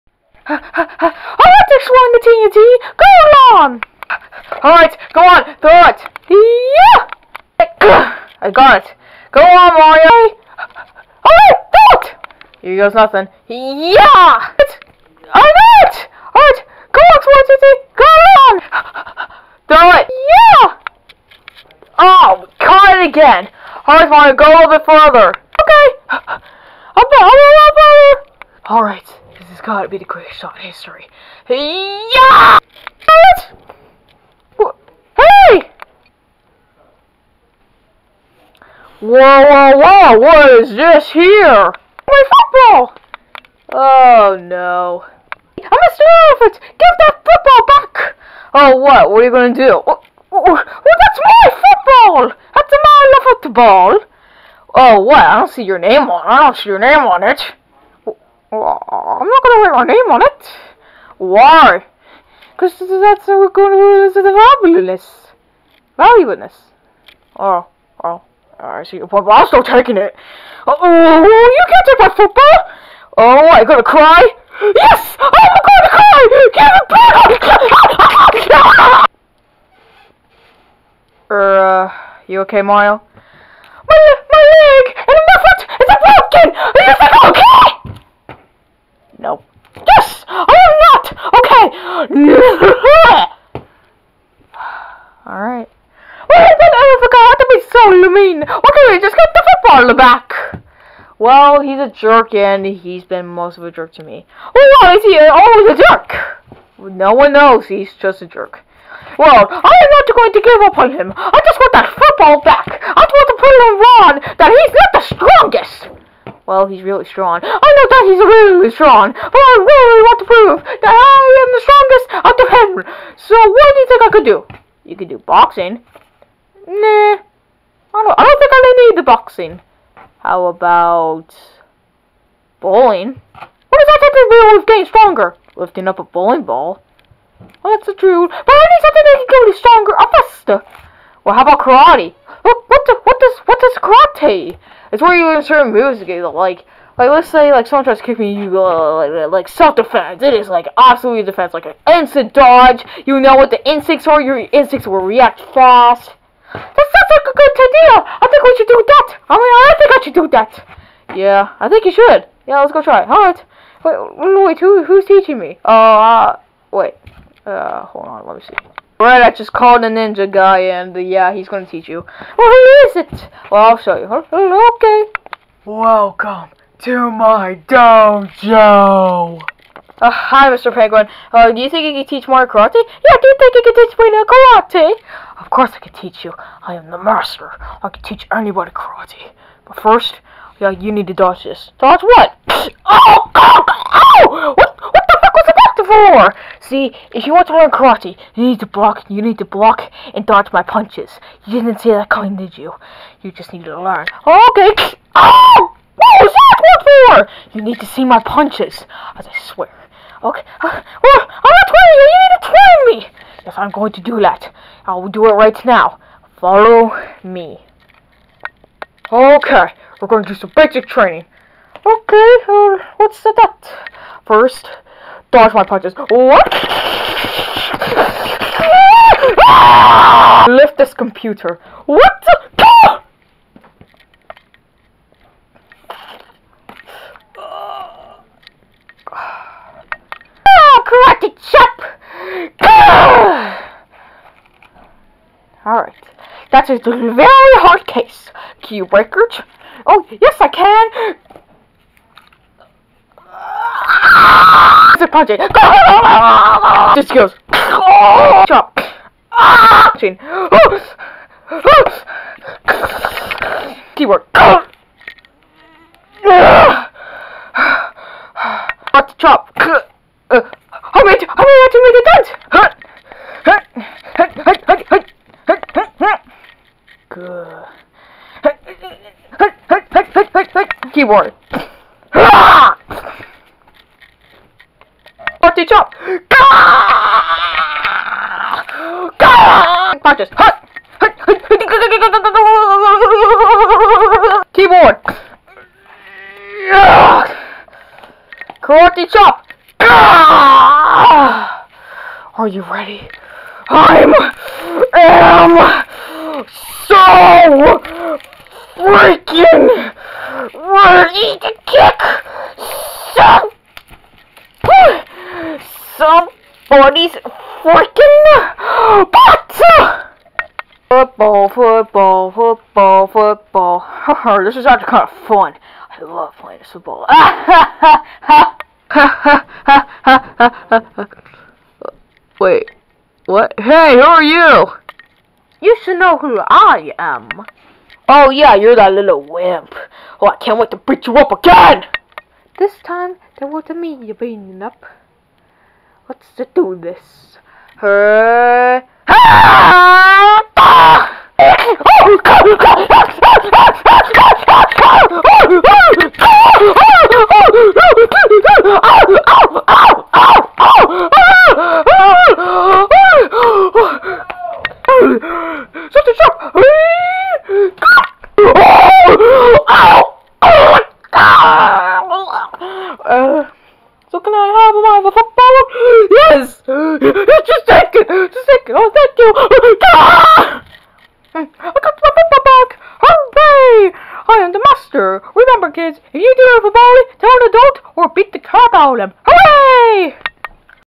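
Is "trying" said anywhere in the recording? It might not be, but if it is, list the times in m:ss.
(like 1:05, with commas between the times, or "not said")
3:31.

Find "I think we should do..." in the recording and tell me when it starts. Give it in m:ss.
2:38.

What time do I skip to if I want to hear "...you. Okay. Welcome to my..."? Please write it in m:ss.
2:53.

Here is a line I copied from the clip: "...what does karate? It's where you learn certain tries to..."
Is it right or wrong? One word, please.
wrong.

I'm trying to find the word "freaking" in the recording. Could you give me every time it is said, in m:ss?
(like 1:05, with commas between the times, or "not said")
5:08, 5:17.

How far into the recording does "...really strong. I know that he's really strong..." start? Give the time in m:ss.
1:56.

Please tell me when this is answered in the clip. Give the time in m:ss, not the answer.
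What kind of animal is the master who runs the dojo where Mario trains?
3:00.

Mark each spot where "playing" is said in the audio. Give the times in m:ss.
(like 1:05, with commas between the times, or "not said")
5:26.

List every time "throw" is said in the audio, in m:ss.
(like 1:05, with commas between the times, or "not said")
0:05, 0:11, 0:19.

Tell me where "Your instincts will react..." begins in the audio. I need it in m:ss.
2:34.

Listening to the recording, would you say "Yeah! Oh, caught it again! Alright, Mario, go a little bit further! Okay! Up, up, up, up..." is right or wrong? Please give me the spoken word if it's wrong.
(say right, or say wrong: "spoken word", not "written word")
right.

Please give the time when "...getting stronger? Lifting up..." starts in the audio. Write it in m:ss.
2:14.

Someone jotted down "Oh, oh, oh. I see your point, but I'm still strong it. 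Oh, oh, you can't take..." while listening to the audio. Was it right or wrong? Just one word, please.
wrong.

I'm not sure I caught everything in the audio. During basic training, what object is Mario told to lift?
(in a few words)
computer.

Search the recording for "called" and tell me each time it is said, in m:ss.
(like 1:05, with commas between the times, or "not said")
2:49.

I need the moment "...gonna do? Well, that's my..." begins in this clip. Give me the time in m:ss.
0:49.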